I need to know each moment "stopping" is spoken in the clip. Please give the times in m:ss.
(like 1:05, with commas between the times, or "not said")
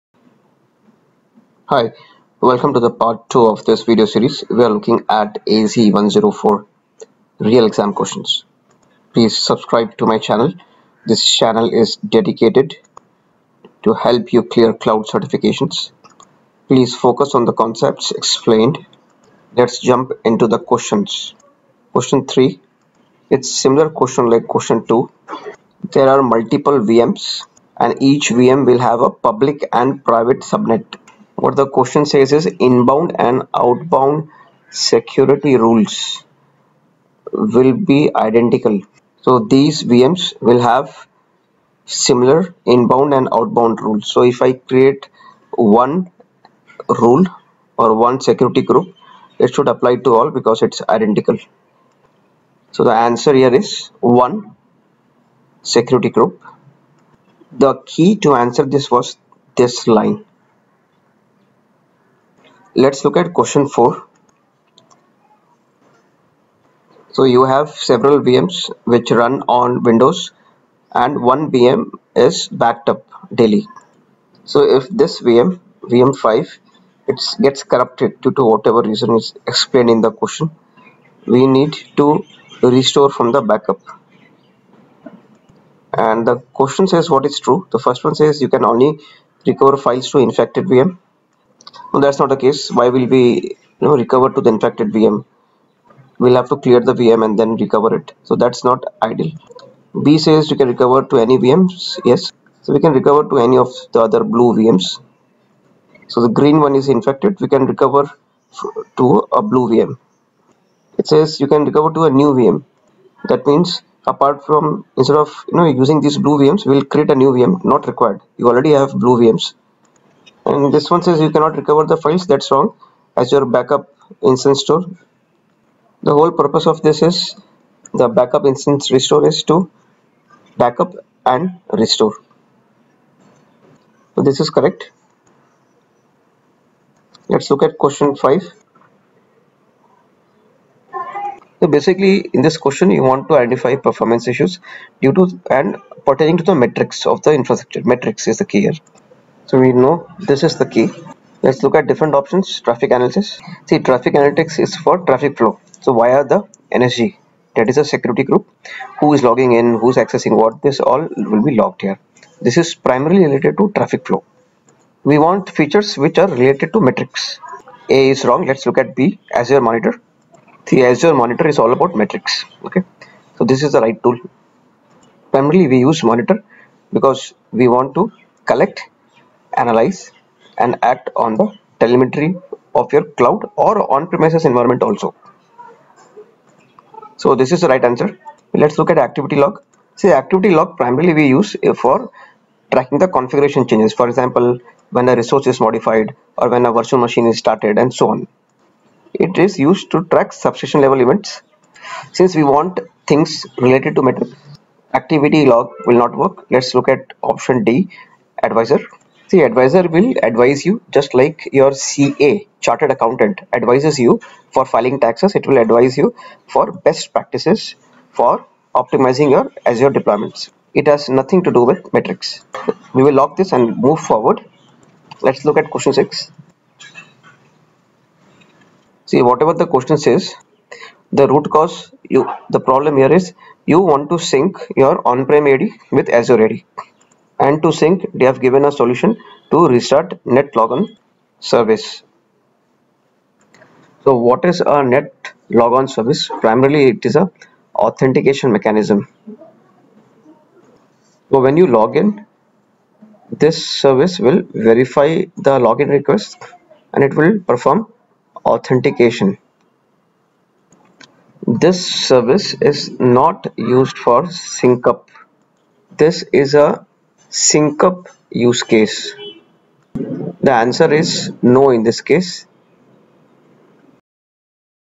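not said.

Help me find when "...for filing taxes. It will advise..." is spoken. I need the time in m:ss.
3:34.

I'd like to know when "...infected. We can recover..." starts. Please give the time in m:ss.
1:46.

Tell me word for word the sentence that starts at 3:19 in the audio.
It is used to track subscription level events.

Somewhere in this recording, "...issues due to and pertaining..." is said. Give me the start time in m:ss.
2:24.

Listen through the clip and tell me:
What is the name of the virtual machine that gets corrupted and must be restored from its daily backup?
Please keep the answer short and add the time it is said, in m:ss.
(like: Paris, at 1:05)
VM5, at 1:15.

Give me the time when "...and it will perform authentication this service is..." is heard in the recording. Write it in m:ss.
4:16.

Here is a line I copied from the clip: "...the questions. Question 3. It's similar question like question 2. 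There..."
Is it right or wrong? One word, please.
right.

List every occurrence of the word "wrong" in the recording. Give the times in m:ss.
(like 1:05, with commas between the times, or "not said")
2:02, 2:48.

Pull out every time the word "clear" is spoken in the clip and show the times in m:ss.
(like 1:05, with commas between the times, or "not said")
0:14, 1:36.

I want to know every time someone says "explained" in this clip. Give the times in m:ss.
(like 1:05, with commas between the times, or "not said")
0:18, 1:19.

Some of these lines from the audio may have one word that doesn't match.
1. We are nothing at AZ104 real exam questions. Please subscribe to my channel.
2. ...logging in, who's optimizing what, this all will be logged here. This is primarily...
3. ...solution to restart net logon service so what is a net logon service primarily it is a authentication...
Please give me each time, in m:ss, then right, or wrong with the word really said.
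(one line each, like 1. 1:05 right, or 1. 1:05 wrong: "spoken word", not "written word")
1. 0:04 wrong: "looking", not "nothing"
2. 2:39 wrong: "accessing", not "optimizing"
3. 3:58 right.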